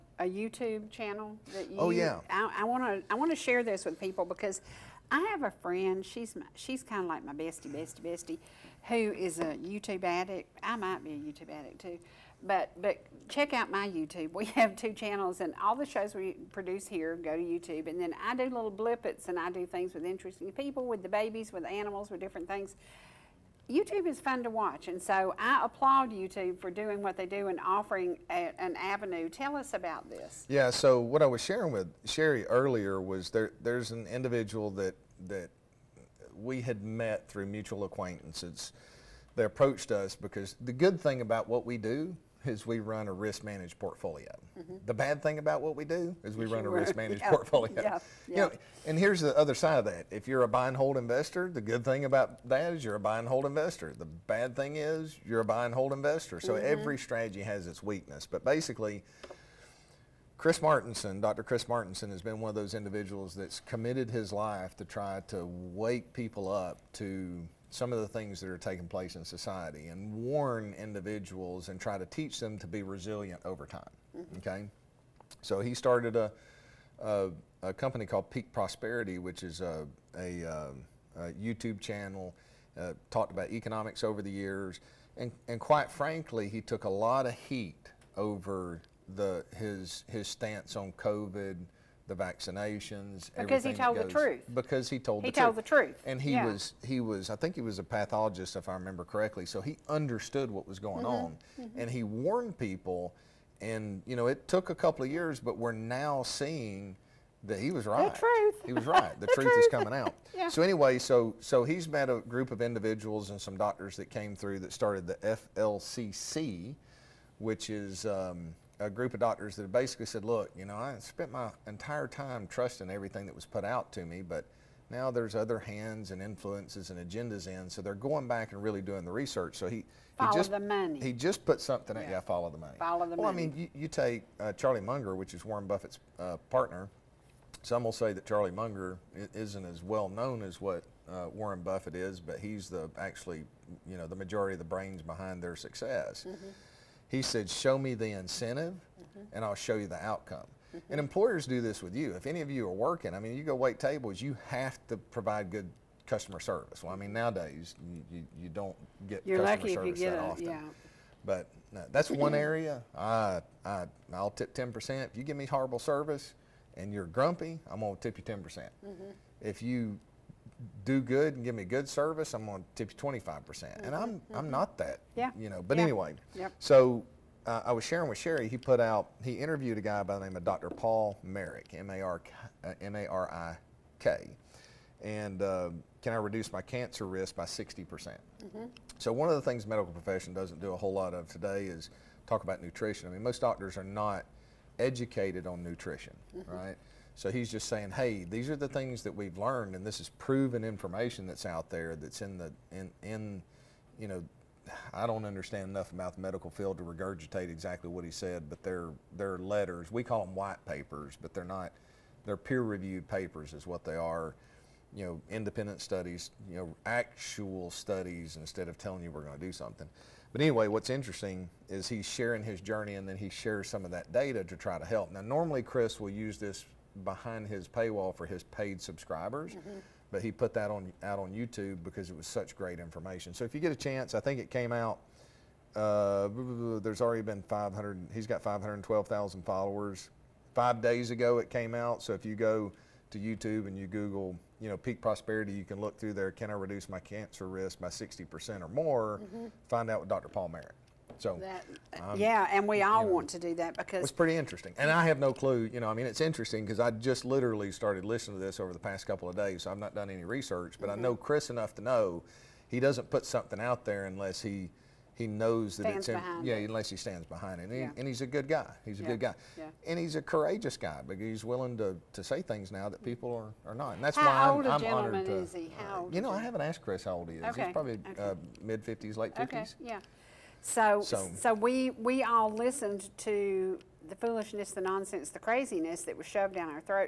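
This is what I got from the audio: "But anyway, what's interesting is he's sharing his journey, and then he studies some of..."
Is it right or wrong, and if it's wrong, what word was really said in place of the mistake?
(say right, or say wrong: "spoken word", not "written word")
wrong: "shares", not "studies".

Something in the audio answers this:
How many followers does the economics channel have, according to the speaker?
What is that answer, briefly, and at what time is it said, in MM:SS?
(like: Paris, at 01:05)
512,000, at 03:58.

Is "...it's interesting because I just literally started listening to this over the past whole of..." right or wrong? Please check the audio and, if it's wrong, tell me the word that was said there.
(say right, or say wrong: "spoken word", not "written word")
wrong: "couple", not "whole".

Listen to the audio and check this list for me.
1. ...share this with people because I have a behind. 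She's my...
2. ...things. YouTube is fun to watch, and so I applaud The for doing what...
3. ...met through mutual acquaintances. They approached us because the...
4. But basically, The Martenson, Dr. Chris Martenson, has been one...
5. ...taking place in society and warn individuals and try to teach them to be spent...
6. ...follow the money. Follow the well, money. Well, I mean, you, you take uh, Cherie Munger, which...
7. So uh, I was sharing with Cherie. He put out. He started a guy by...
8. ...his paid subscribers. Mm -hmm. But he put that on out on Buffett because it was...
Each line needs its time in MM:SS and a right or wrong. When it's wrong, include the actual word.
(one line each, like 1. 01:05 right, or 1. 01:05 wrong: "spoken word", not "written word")
1. 00:03 wrong: "friend", not "behind"
2. 00:22 wrong: "YouTube", not "The"
3. 00:36 right
4. 00:58 wrong: "Chris", not "The"
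5. 01:08 wrong: "resilient", not "spent"
6. 02:12 wrong: "Charlie", not "Cherie"
7. 02:56 wrong: "interviewed", not "started"
8. 03:48 wrong: "YouTube", not "Buffett".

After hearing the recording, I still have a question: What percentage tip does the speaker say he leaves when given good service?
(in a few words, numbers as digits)
25%.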